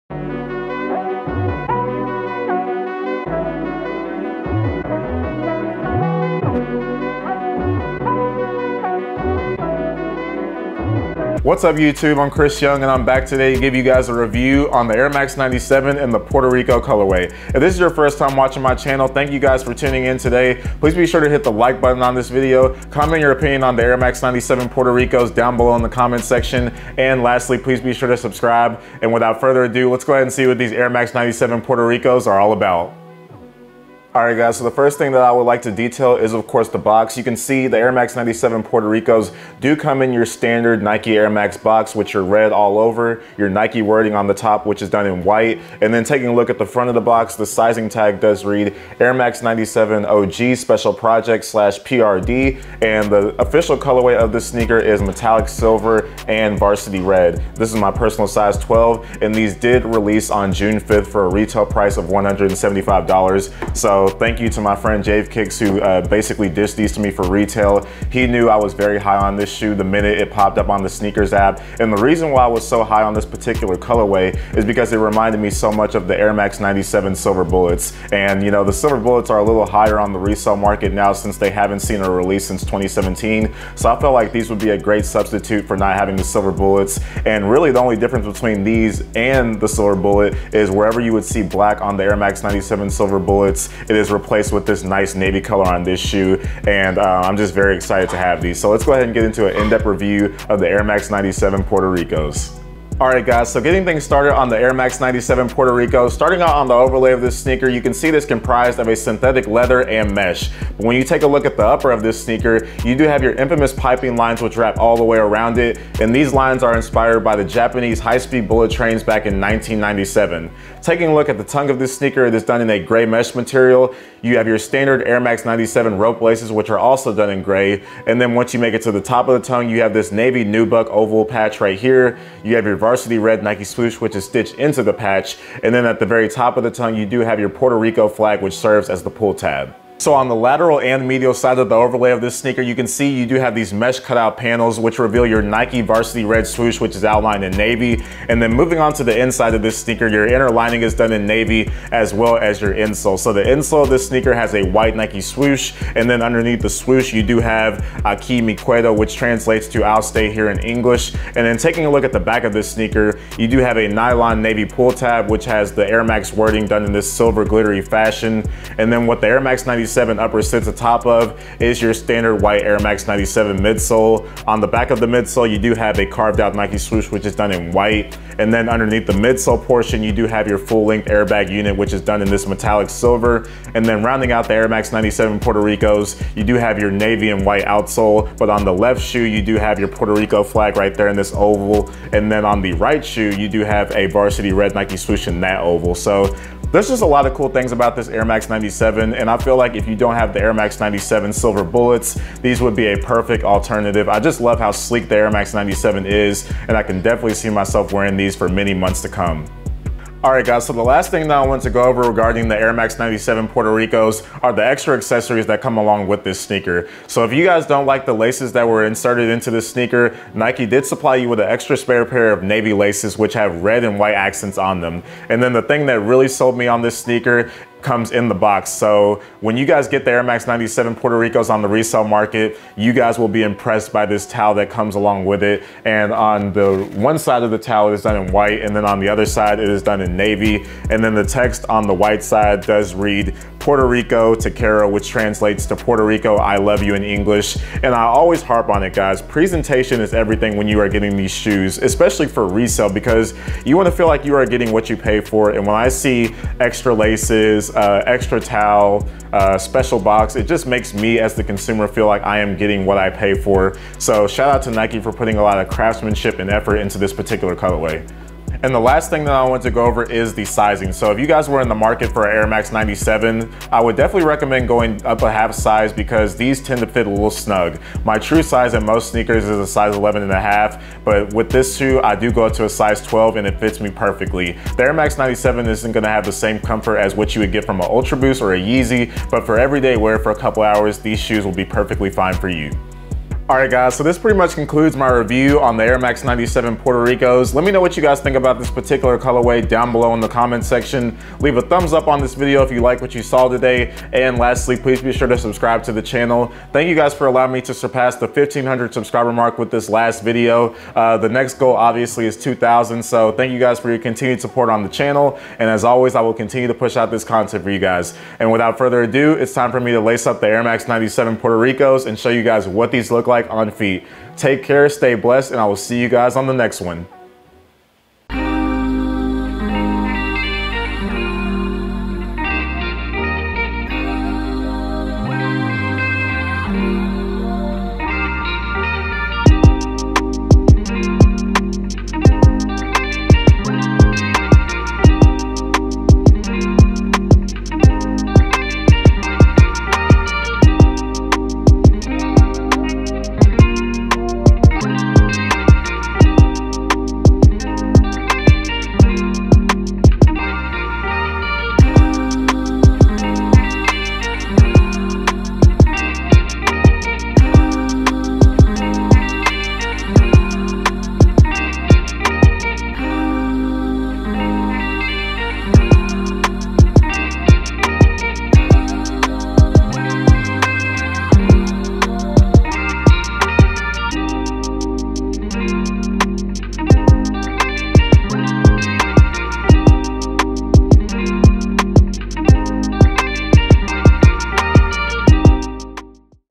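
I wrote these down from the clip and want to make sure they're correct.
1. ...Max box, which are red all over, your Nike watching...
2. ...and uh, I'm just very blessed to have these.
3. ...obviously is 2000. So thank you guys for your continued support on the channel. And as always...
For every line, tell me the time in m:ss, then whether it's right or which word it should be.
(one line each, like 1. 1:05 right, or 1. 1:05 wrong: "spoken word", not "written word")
1. 0:41 wrong: "wording", not "watching"
2. 1:36 wrong: "excited", not "blessed"
3. 5:11 right.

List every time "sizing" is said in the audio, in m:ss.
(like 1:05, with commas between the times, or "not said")
0:47, 4:30.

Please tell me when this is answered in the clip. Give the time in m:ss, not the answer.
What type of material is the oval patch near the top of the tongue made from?
2:10.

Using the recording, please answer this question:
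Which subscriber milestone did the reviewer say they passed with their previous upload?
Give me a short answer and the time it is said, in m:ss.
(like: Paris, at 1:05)
1500, at 5:08.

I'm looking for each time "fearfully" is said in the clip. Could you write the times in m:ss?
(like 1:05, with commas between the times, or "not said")
not said.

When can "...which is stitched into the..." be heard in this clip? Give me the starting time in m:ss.
2:14.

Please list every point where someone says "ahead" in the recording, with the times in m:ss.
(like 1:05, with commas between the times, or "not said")
0:30, 1:38.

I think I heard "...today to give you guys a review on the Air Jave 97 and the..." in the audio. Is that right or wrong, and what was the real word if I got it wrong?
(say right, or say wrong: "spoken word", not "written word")
wrong: "Max", not "Jave".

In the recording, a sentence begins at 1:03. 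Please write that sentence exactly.
So so thank you to my friend Jave Kicks who uh, basically dished these to me for retail.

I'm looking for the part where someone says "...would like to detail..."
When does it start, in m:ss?
0:35.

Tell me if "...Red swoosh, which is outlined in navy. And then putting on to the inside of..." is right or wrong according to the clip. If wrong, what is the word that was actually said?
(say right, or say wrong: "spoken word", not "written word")
wrong: "moving", not "putting".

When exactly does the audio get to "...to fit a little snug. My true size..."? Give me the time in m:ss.
4:36.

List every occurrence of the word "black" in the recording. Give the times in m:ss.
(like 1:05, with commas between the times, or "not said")
1:31.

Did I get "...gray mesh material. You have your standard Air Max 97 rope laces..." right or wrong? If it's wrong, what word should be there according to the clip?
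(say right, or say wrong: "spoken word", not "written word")
right.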